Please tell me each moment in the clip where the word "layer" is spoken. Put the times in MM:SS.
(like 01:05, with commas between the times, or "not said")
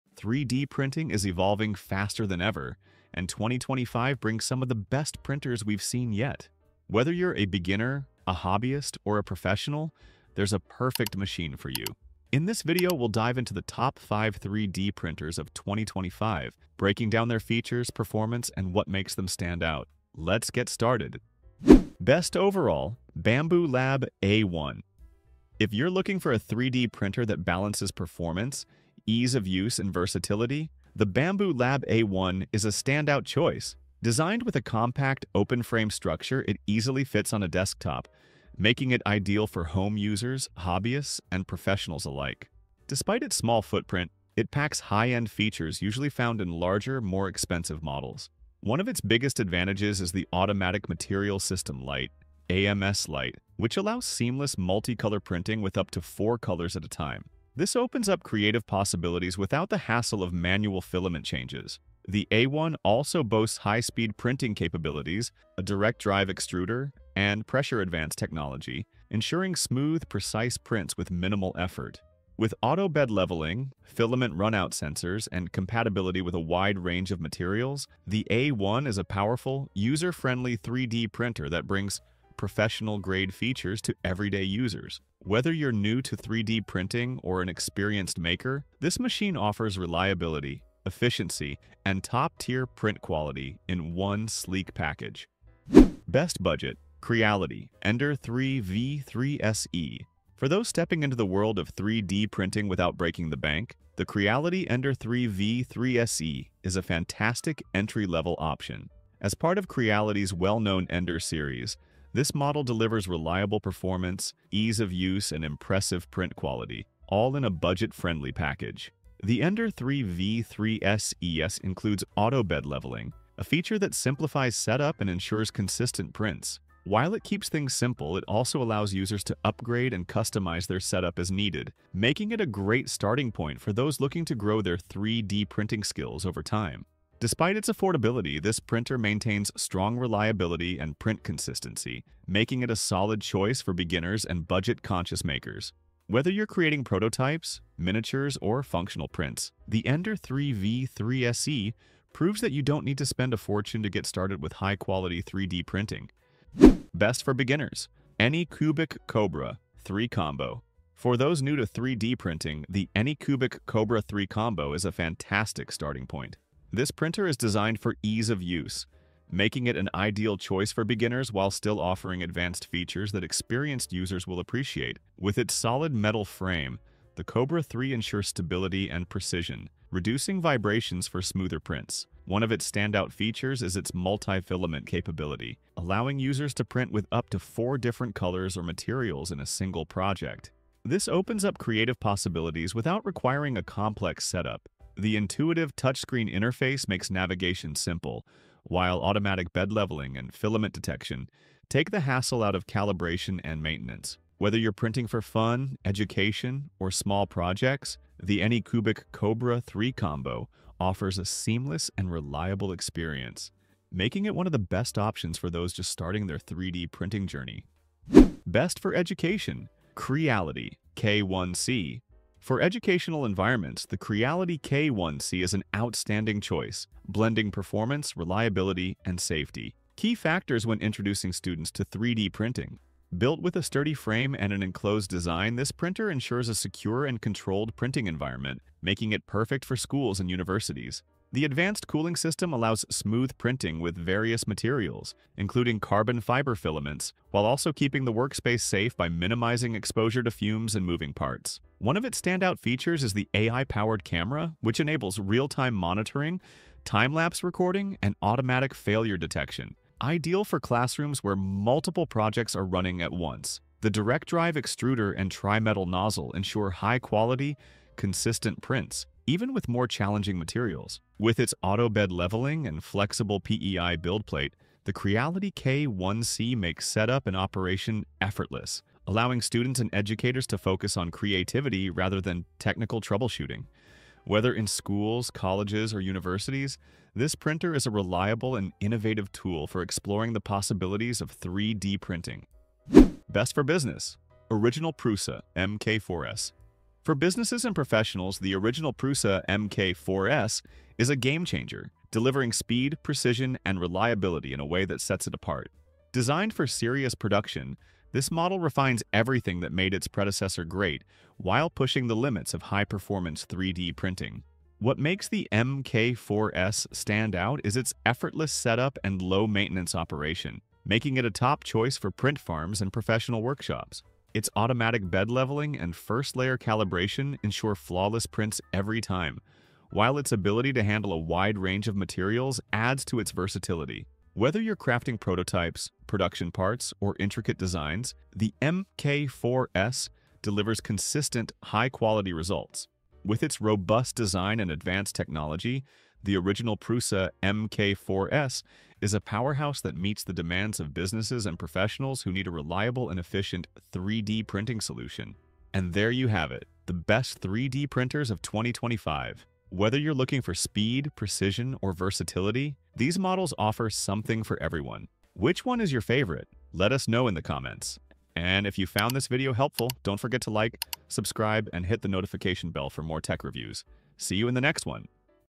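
05:26.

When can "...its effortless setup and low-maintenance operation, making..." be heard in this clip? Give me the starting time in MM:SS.
05:17.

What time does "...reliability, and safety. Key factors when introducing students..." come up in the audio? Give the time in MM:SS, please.
03:48.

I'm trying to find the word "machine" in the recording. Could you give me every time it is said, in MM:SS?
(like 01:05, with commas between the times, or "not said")
00:11, 01:28.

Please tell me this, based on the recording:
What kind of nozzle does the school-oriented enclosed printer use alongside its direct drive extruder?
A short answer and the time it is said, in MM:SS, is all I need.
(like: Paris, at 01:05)
tri-metal nozzle, at 04:25.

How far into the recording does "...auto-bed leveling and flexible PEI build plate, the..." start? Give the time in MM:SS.
04:31.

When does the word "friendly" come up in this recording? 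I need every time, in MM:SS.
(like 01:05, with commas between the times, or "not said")
01:19, 01:57.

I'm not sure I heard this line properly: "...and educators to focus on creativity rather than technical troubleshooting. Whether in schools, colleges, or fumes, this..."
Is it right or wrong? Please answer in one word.
wrong.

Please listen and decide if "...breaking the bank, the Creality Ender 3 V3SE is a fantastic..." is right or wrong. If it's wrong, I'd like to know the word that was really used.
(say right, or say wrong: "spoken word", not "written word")
right.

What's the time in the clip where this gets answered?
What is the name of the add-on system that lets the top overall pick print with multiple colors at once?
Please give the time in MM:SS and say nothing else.
00:52.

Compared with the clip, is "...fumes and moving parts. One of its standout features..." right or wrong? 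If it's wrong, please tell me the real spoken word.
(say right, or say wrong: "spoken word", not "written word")
right.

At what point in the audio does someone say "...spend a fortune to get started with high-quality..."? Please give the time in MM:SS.
02:33.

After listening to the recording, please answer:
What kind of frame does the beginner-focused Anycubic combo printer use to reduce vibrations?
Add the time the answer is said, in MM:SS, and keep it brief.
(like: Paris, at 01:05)
solid metal frame, at 02:55.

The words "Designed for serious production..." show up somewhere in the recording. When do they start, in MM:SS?
05:06.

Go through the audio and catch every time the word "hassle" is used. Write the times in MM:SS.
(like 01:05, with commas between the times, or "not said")
00:59, 03:22.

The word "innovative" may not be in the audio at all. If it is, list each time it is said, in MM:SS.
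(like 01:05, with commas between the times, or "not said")
04:48.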